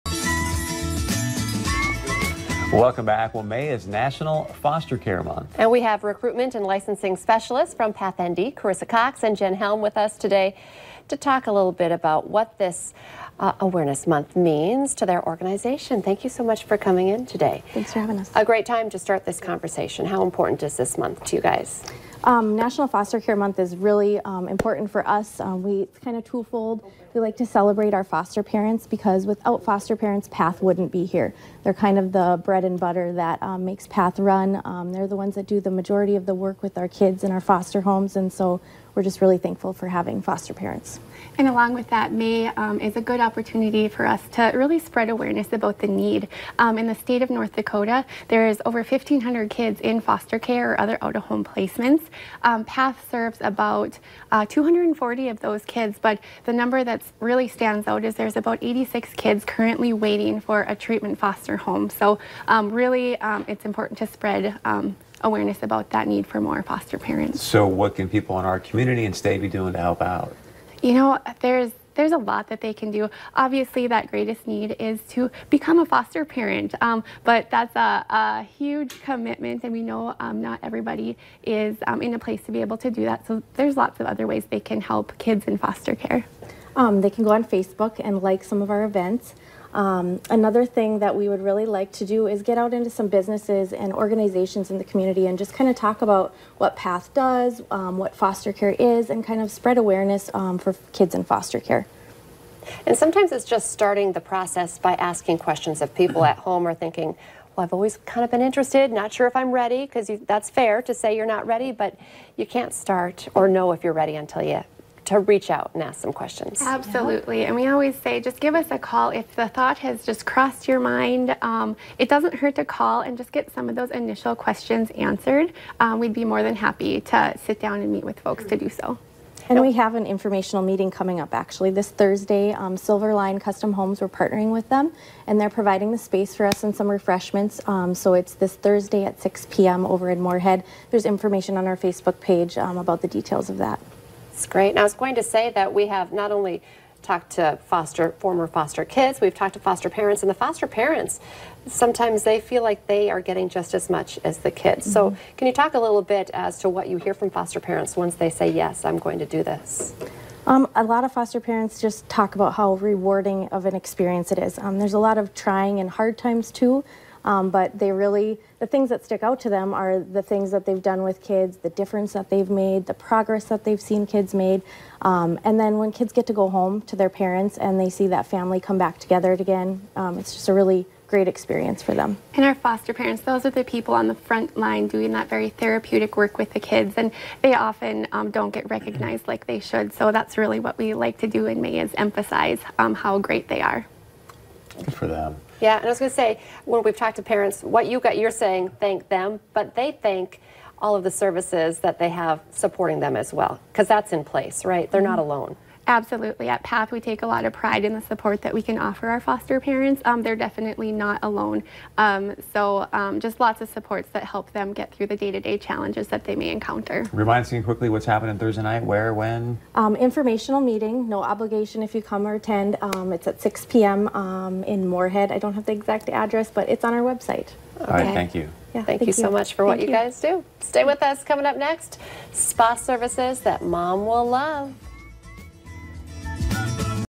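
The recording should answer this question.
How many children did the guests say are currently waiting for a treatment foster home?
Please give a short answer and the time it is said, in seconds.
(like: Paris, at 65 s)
86, at 58 s.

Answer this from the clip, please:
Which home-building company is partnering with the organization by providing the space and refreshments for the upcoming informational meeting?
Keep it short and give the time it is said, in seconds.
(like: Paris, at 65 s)
Silver Line Custom Homes, at 132 s.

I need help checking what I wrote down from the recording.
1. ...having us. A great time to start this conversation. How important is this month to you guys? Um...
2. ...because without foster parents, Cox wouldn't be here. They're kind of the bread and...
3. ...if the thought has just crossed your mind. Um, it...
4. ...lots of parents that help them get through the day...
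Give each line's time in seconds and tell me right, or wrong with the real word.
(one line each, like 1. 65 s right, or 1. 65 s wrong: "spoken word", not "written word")
1. 17 s right
2. 28 s wrong: "PATH", not "Cox"
3. 119 s right
4. 213 s wrong: "supports", not "parents".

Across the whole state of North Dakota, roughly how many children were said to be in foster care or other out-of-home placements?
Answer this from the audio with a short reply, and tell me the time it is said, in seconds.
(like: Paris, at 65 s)
1,500, at 48 s.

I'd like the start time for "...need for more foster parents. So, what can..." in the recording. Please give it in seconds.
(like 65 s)
66 s.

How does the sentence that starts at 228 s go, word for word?
Yeah, thank, thank you, you, so much for thank what you, you guys do.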